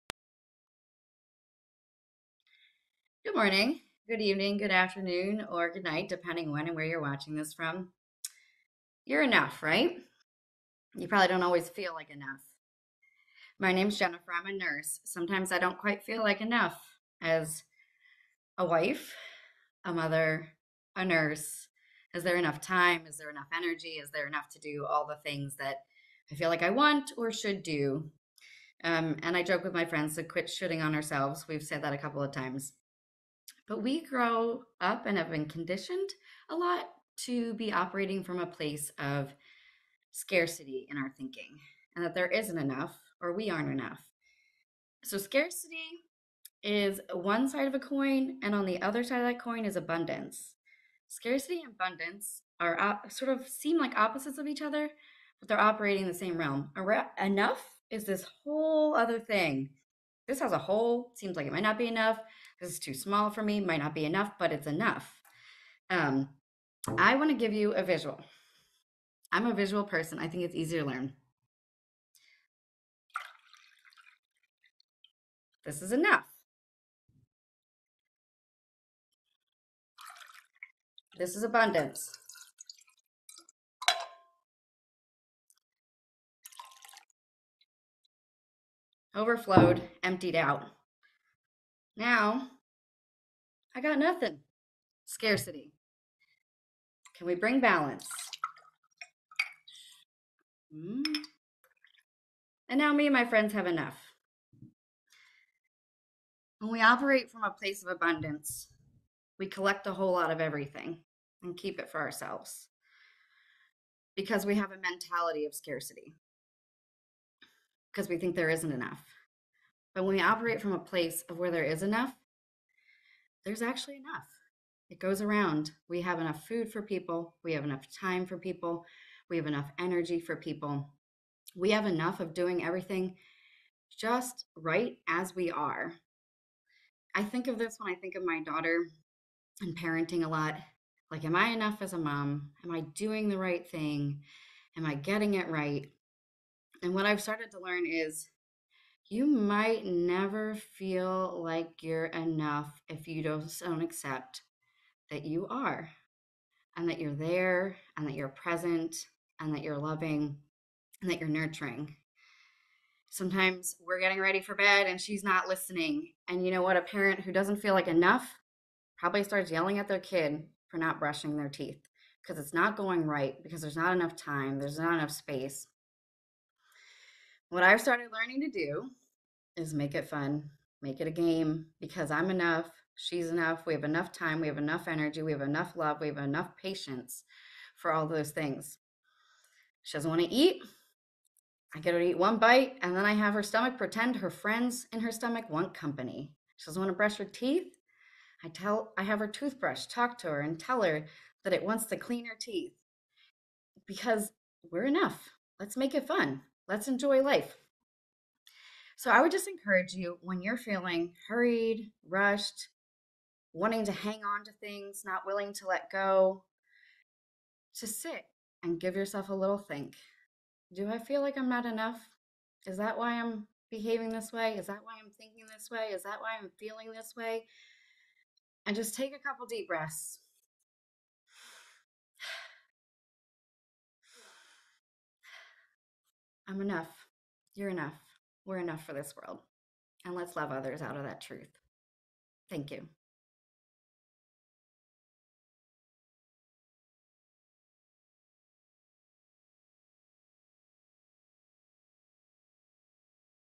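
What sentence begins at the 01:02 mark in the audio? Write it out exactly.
This is too small for me, might not be enough, but it's enough.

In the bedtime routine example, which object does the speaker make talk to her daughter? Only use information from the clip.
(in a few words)
Her toothbrush.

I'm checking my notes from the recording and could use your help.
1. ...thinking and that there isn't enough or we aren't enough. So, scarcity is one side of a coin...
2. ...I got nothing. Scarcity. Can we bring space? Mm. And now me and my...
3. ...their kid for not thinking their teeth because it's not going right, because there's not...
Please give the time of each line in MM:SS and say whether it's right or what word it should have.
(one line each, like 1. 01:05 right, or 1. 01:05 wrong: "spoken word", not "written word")
1. 00:41 right
2. 01:33 wrong: "balance", not "space"
3. 02:49 wrong: "brushing", not "thinking".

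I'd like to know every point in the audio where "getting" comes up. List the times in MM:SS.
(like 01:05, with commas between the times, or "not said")
02:24, 02:43.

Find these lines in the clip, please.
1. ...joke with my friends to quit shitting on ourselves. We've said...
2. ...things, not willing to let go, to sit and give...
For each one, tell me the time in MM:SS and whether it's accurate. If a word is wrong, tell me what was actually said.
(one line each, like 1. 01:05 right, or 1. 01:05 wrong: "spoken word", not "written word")
1. 00:29 right
2. 03:34 right.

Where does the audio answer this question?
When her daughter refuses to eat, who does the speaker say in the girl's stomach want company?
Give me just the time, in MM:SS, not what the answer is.
03:14.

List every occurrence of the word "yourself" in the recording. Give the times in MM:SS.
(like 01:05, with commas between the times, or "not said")
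03:38.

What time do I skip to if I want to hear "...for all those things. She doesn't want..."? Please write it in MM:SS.
03:07.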